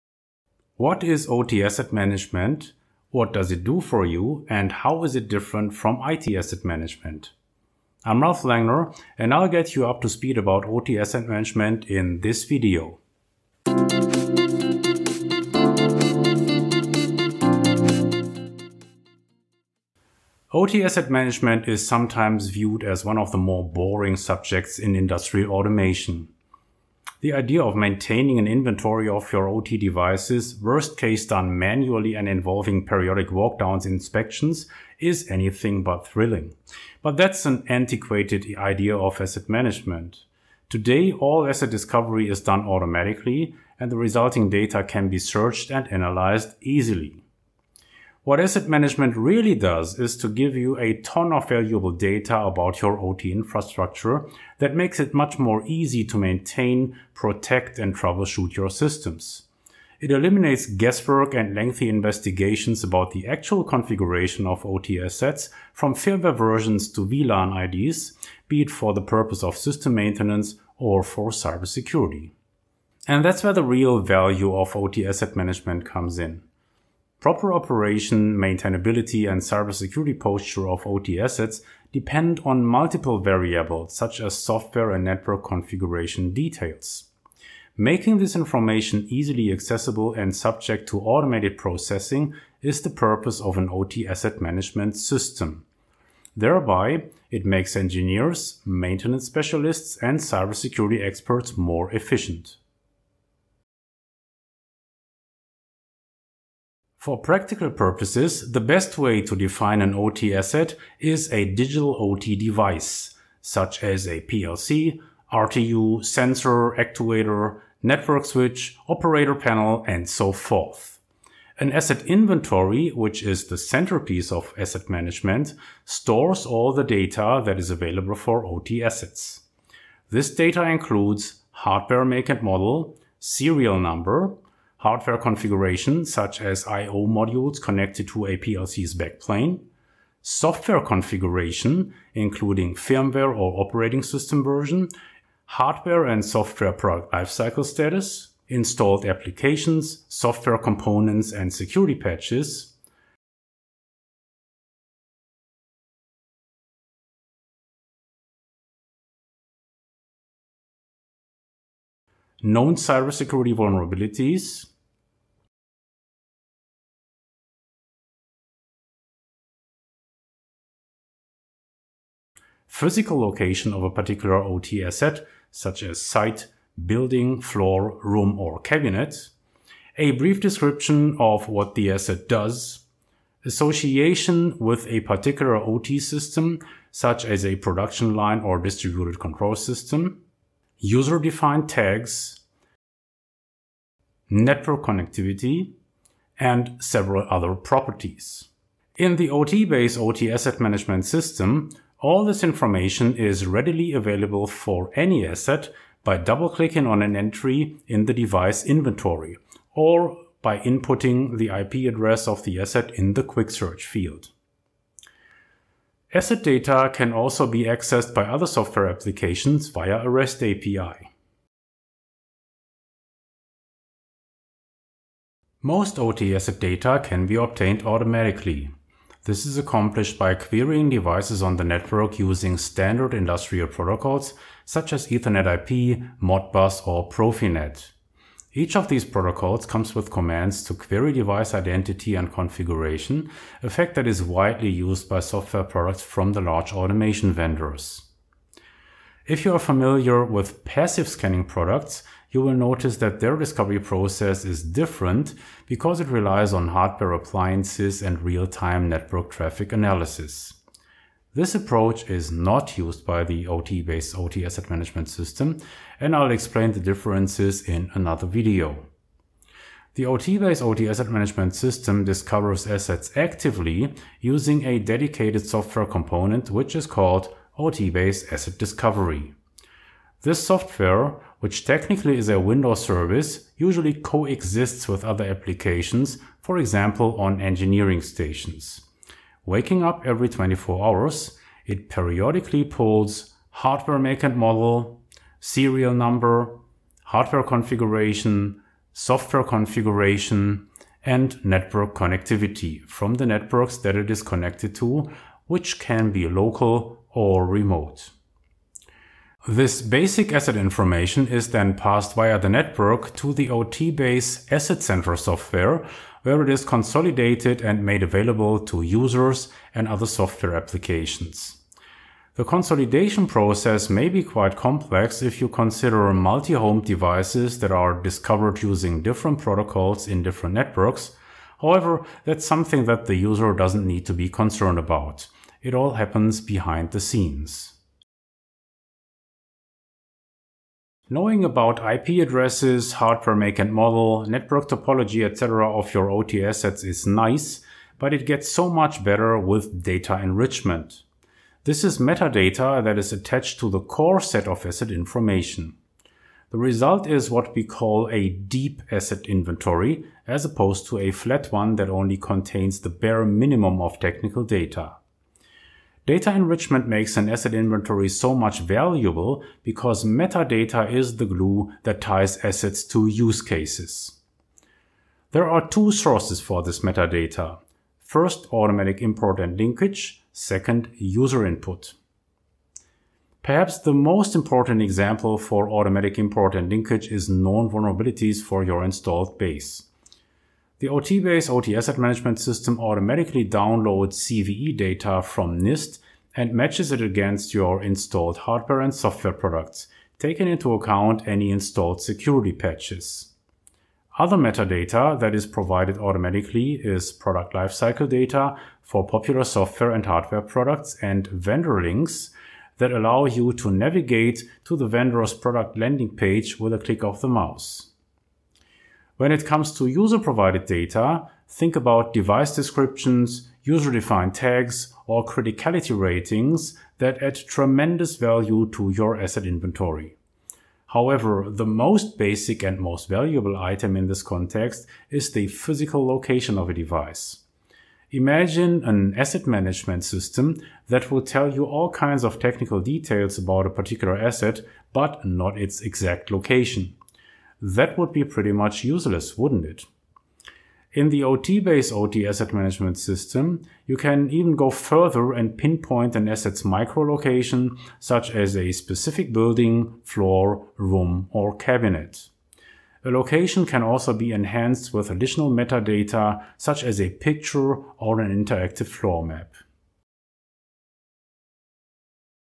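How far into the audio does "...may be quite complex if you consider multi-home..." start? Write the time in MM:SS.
05:23.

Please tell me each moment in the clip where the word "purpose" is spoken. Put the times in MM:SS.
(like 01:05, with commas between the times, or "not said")
01:09, 01:32, 01:47.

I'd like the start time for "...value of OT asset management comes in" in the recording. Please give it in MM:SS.
01:13.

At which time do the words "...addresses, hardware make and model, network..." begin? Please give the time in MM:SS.
05:42.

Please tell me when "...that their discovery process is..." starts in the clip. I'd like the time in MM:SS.
04:12.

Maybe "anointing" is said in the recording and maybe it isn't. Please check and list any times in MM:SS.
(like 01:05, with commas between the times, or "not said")
not said.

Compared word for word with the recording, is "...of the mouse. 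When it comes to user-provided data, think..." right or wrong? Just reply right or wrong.
right.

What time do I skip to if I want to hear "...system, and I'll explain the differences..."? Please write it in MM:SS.
04:25.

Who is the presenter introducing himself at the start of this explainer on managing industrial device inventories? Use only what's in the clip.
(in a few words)
Ralph Langner.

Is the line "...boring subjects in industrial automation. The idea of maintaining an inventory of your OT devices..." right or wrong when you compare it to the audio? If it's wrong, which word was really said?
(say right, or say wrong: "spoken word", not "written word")
right.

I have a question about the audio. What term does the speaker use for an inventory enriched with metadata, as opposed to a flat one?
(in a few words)
deep asset inventory.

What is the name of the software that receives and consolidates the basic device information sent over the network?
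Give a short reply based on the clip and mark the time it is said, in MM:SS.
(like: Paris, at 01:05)
OTbase Asset Center, at 05:13.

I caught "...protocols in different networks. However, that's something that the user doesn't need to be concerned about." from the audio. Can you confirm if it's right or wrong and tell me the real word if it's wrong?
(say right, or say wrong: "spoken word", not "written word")
right.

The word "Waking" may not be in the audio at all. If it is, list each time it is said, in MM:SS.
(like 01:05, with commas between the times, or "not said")
04:49.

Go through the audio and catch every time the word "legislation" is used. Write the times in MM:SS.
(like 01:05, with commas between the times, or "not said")
not said.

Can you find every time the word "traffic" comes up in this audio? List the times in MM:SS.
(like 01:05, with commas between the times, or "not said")
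04:19.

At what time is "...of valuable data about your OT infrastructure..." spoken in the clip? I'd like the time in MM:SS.
00:51.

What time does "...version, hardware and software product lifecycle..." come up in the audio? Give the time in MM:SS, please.
02:24.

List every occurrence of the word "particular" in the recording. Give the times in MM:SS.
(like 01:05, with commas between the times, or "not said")
02:53, 03:05, 07:23.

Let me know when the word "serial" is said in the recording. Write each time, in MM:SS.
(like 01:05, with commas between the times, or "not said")
02:13, 04:55.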